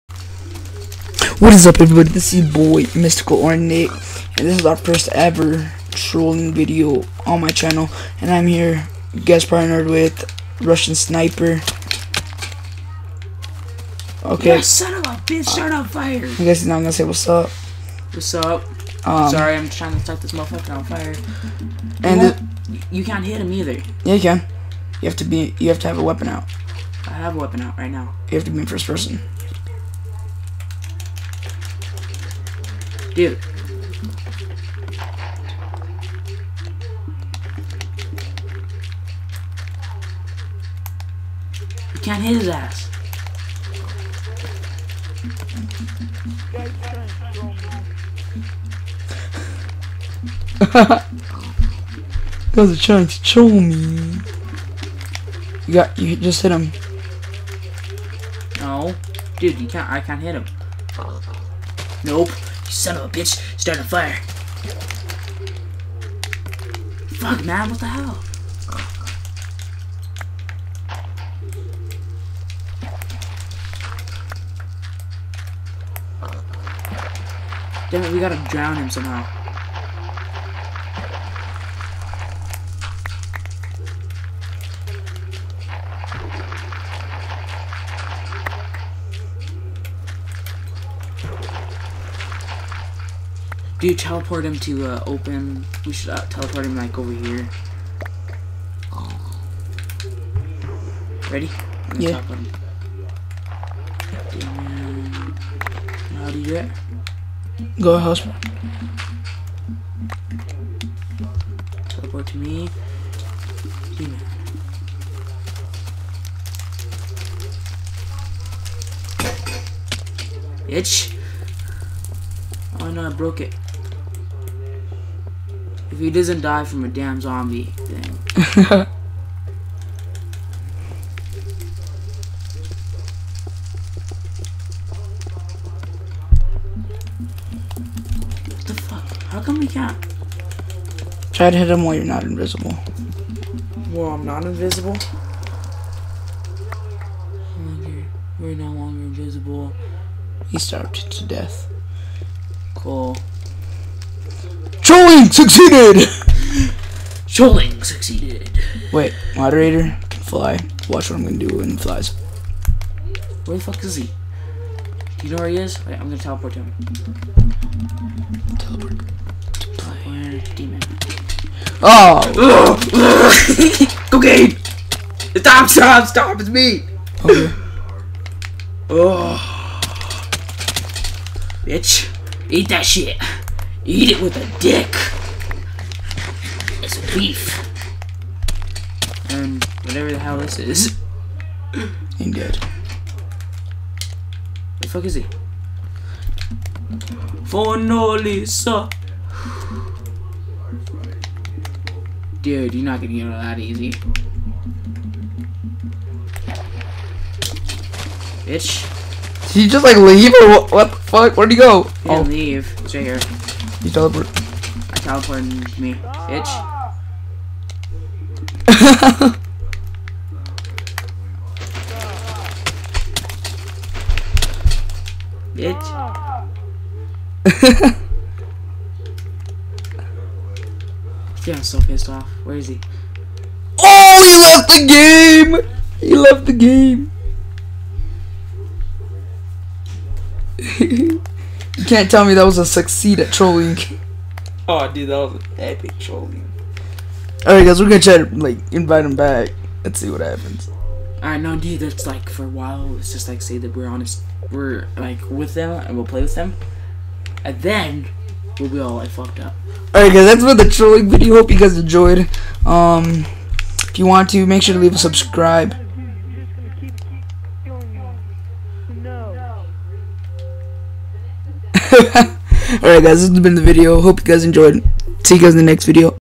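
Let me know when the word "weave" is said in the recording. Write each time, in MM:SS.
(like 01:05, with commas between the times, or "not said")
not said.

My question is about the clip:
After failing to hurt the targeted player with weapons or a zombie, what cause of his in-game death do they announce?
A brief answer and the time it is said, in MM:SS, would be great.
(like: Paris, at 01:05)
He starved to death, at 02:30.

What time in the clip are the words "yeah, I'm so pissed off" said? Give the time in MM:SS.
03:51.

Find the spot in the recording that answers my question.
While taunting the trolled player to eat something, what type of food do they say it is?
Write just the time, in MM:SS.
03:07.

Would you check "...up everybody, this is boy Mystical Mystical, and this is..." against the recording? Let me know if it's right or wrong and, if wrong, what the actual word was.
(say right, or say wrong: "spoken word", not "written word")
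wrong: "Ornate", not "Mystical".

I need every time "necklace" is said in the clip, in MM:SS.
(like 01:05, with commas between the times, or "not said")
not said.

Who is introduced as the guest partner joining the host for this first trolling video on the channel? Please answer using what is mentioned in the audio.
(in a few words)
Russian Sniper.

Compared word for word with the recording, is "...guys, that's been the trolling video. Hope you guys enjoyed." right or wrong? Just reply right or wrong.
right.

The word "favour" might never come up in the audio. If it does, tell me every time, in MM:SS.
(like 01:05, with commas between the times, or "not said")
not said.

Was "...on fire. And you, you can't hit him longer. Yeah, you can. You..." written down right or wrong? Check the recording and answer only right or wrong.
wrong.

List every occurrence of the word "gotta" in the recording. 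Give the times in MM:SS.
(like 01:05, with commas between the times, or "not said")
01:18.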